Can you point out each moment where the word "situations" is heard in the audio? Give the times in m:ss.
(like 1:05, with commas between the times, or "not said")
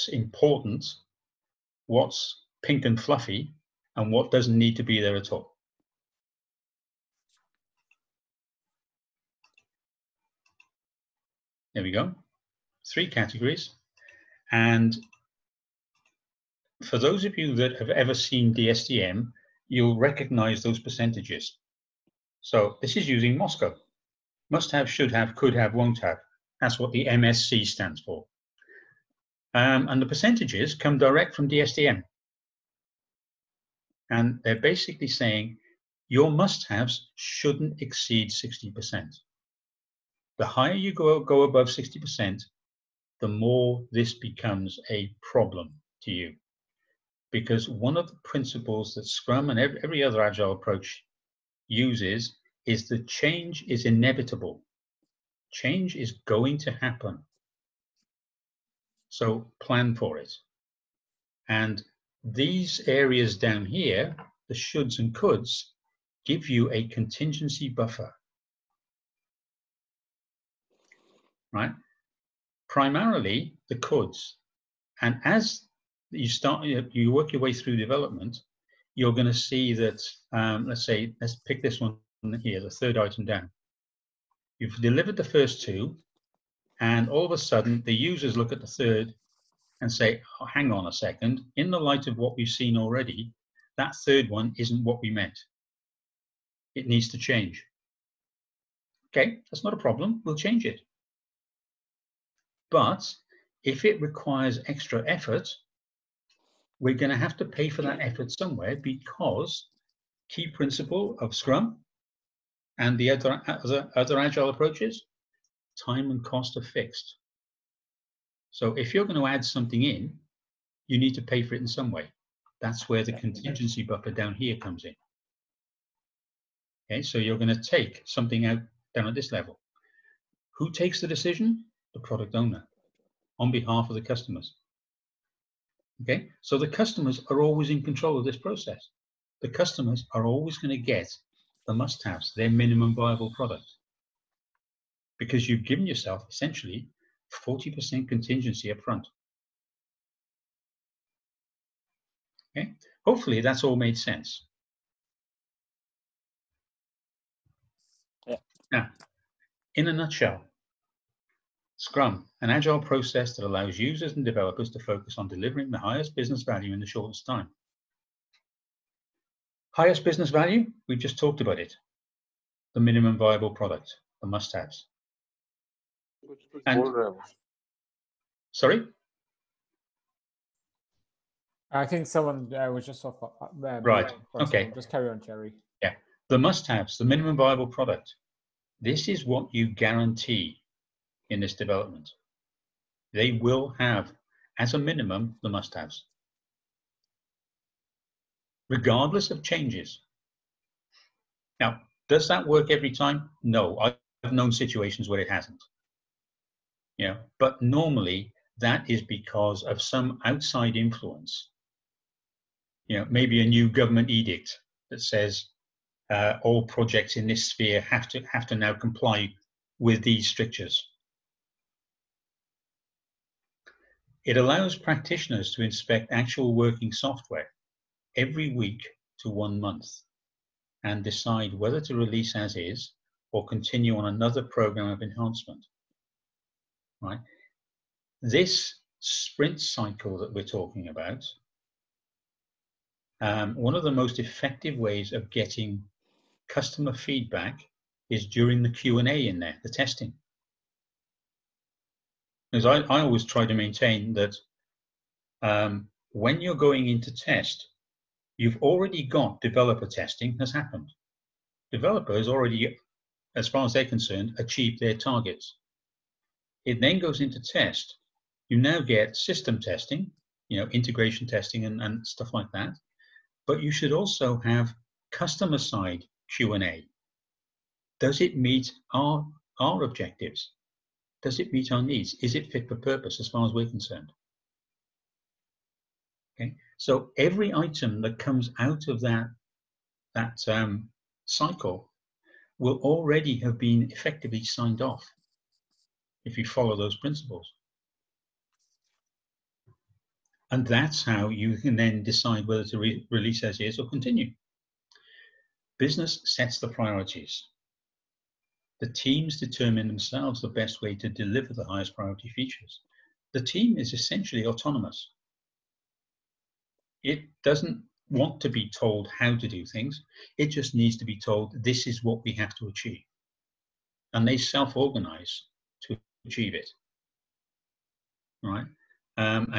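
3:24.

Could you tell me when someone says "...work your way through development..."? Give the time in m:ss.
1:17.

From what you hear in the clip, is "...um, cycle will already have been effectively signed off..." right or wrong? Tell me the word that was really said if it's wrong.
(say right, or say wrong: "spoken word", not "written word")
right.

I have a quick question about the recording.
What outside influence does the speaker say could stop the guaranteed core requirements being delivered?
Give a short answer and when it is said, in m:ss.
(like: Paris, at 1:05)
A new government edict, at 3:33.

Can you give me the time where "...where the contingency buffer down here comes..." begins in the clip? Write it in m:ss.
2:02.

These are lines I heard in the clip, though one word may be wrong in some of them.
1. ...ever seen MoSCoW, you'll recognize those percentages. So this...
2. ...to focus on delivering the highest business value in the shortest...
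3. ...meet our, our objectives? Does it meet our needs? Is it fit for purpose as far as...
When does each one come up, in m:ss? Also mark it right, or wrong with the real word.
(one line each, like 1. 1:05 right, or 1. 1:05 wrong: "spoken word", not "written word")
1. 0:17 wrong: "DSDM", not "MoSCoW"
2. 2:44 right
3. 4:38 right.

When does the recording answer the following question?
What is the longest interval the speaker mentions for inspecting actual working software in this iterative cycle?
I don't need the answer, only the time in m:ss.
3:49.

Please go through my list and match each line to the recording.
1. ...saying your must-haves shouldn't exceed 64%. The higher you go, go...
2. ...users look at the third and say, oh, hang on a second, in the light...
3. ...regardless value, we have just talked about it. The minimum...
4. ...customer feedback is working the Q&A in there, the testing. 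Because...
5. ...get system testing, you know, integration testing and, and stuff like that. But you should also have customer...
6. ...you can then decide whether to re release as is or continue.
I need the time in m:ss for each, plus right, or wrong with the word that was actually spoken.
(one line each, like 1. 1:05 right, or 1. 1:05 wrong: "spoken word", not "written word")
1. 0:35 wrong: "60", not "64"
2. 1:27 right
3. 2:50 wrong: "business", not "regardless"
4. 4:06 wrong: "during", not "working"
5. 4:28 right
6. 5:01 right.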